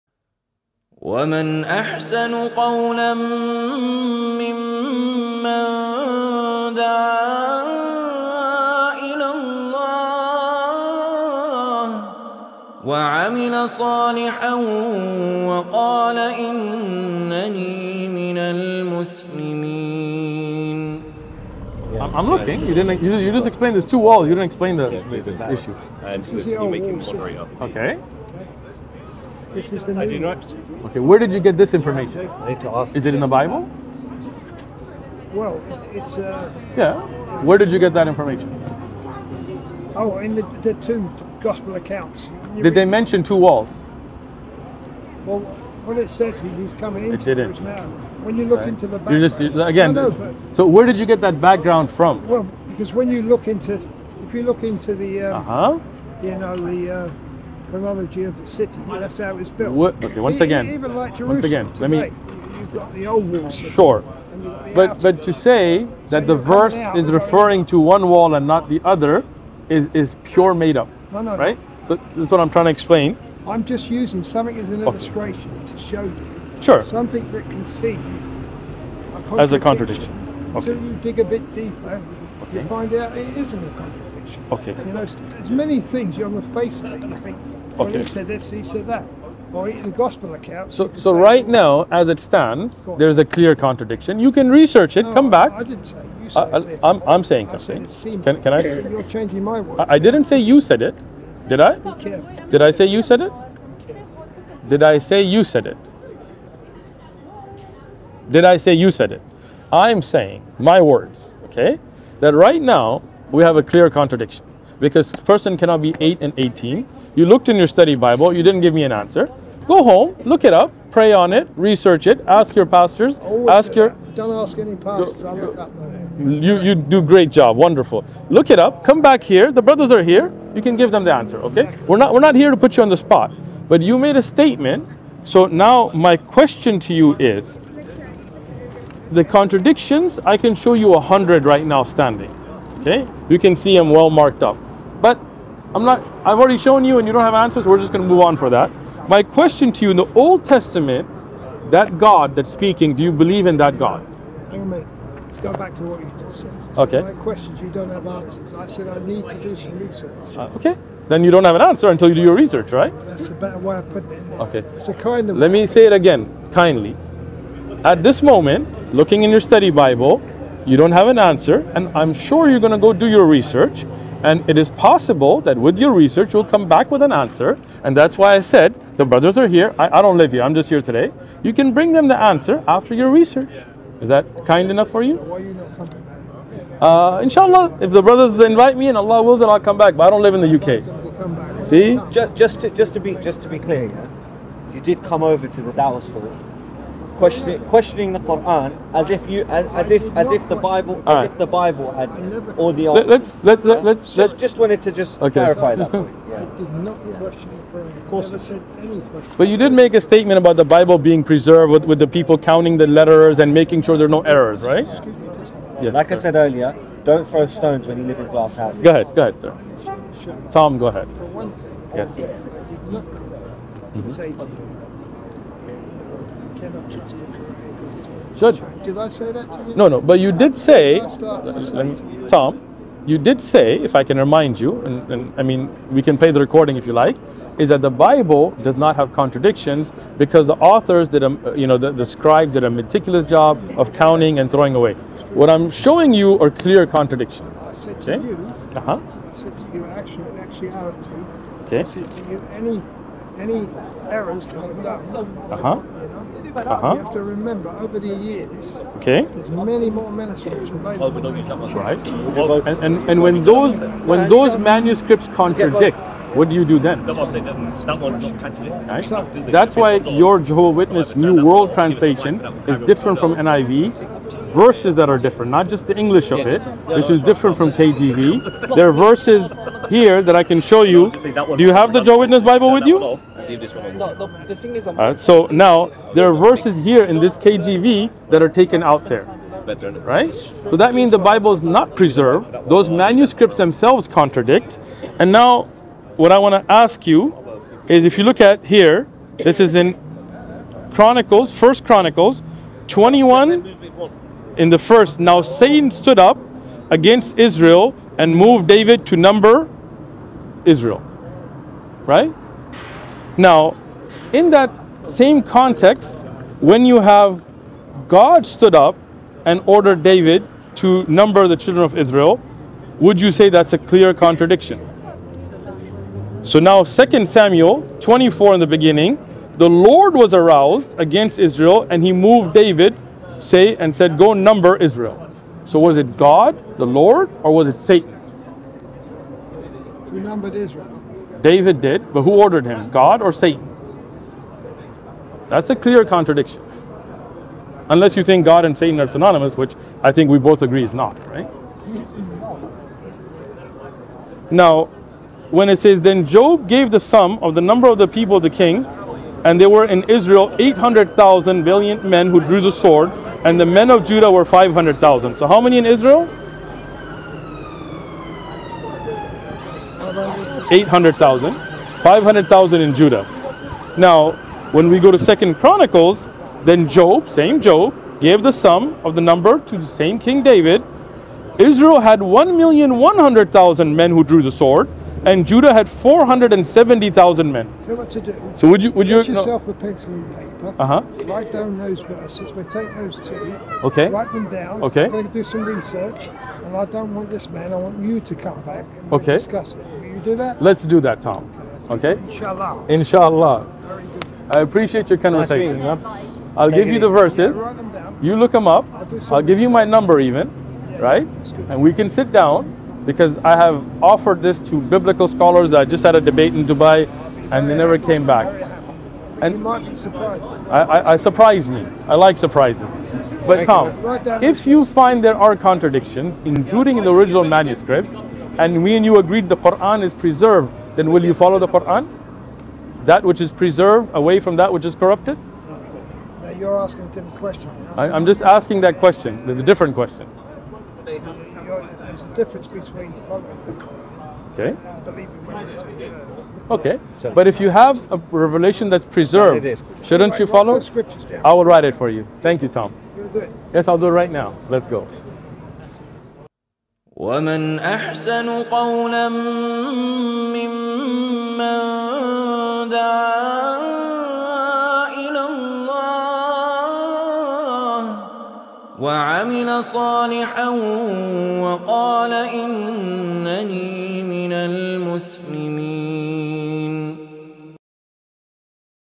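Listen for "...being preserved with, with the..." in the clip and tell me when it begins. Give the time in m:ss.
3:31.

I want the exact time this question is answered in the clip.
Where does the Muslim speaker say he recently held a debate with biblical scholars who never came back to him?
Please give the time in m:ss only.
6:56.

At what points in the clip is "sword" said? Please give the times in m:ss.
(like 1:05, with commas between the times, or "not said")
6:02, 6:24.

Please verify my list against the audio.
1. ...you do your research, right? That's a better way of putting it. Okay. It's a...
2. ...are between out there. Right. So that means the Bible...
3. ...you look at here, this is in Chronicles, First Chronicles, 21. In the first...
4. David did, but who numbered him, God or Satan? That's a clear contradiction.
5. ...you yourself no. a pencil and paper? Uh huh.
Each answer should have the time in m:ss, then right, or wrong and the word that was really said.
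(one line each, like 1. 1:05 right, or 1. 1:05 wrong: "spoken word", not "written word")
1. 2:42 right
2. 4:48 wrong: "taken", not "between"
3. 4:58 right
4. 5:41 wrong: "ordered", not "numbered"
5. 6:29 right.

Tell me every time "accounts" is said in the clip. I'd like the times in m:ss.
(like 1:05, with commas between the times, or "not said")
0:41, 1:30.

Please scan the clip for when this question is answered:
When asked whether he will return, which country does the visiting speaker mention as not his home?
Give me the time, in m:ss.
3:10.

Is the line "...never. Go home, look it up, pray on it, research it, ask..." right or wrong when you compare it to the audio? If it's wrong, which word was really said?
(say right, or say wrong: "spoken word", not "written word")
wrong: "answer", not "never".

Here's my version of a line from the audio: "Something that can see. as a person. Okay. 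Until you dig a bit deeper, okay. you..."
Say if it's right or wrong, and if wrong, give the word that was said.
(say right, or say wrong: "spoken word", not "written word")
wrong: "contradiction", not "person".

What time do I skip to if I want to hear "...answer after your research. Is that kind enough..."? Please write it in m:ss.
3:02.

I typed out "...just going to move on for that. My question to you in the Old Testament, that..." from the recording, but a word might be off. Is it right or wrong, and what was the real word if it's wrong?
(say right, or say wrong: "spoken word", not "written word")
right.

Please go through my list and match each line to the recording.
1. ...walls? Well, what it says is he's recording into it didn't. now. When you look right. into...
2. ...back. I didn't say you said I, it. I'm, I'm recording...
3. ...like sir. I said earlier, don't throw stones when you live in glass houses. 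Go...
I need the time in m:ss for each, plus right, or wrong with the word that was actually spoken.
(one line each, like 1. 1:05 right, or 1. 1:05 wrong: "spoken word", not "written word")
1. 0:43 wrong: "coming", not "recording"
2. 1:35 wrong: "saying", not "recording"
3. 3:35 right.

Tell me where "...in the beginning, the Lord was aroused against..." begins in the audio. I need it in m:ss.
5:28.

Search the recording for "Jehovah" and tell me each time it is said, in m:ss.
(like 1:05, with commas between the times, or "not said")
4:30, 4:42.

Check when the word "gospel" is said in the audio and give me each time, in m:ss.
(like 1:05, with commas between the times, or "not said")
0:41, 1:29.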